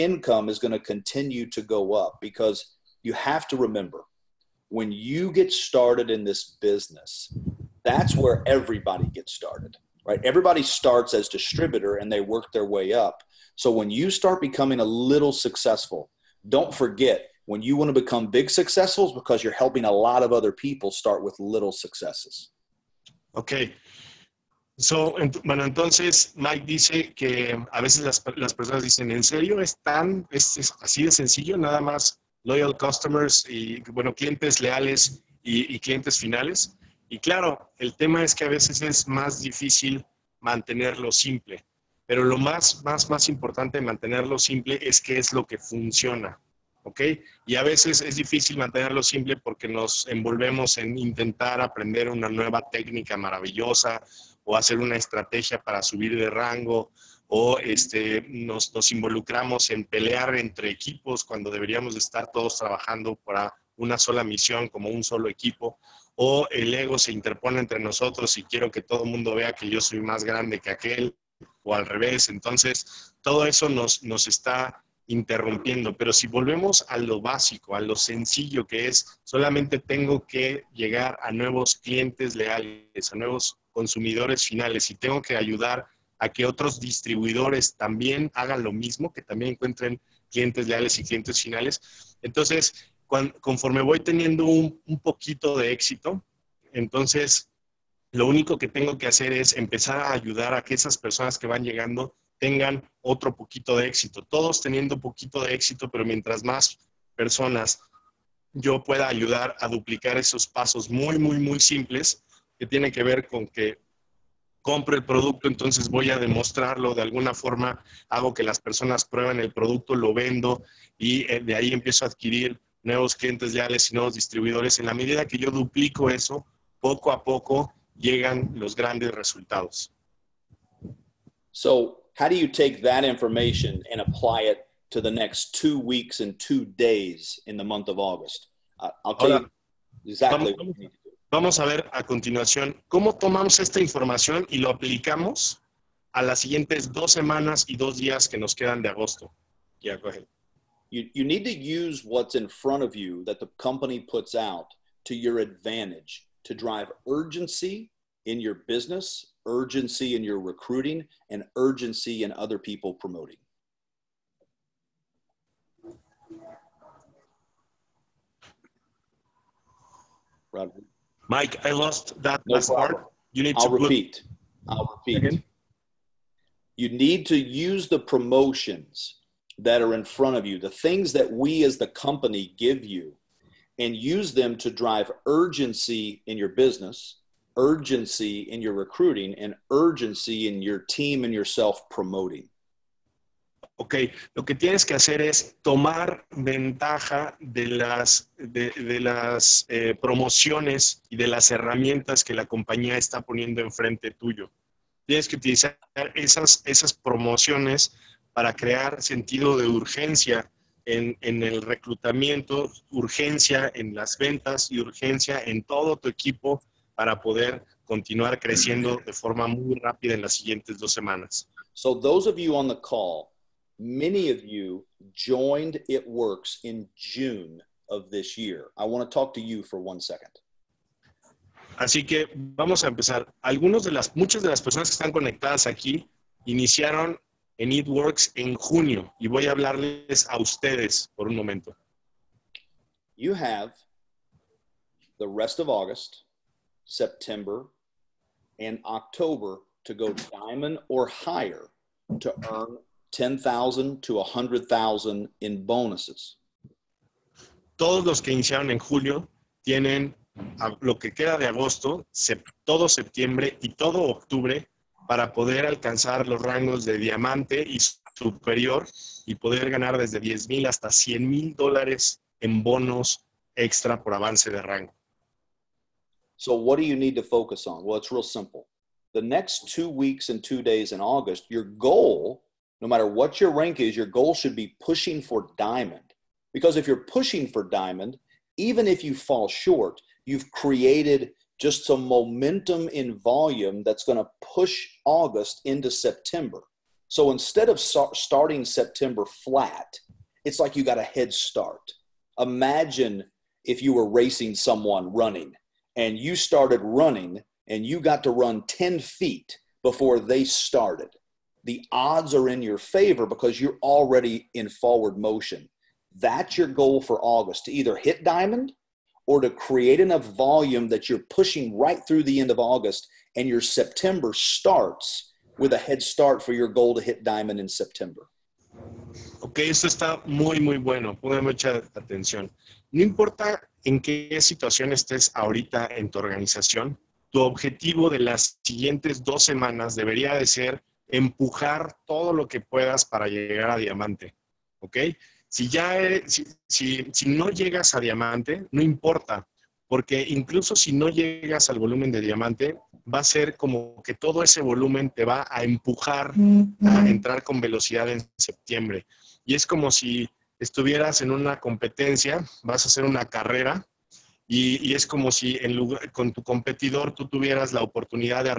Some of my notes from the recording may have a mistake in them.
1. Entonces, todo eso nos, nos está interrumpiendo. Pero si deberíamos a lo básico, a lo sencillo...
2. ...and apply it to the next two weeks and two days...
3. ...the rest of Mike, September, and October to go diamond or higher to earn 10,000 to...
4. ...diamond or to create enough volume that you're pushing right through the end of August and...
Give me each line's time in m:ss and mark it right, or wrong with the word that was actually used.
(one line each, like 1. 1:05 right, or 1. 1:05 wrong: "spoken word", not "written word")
1. 1:12 wrong: "volvemos", not "deberíamos"
2. 2:13 right
3. 4:05 wrong: "August", not "Mike"
4. 5:18 right.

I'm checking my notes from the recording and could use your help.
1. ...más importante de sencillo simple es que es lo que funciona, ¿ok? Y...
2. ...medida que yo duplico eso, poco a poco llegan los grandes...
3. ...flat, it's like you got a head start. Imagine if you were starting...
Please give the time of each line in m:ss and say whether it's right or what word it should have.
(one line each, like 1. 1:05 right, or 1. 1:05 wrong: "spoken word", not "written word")
1. 0:43 wrong: "mantenerlo", not "sencillo"
2. 2:04 right
3. 4:59 wrong: "racing", not "starting".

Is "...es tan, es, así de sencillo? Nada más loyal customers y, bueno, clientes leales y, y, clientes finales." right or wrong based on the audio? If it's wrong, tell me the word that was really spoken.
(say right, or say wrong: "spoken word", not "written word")
right.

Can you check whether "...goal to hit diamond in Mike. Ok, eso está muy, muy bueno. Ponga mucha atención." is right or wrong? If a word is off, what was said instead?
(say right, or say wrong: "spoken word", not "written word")
wrong: "September", not "Mike".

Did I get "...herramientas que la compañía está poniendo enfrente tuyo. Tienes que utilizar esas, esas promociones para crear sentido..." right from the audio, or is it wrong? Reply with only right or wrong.
right.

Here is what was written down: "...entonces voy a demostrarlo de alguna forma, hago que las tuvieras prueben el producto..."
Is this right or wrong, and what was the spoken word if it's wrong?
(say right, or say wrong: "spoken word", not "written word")
wrong: "personas", not "tuvieras".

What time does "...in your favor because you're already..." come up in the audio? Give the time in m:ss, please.
5:12.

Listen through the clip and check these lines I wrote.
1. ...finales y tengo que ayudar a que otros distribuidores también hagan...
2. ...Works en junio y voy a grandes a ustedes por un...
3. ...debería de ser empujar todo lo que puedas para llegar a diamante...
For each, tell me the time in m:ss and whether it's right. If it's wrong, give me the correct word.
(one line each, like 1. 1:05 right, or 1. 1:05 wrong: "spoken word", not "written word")
1. 1:24 right
2. 3:57 wrong: "hablarles", not "grandes"
3. 5:39 right.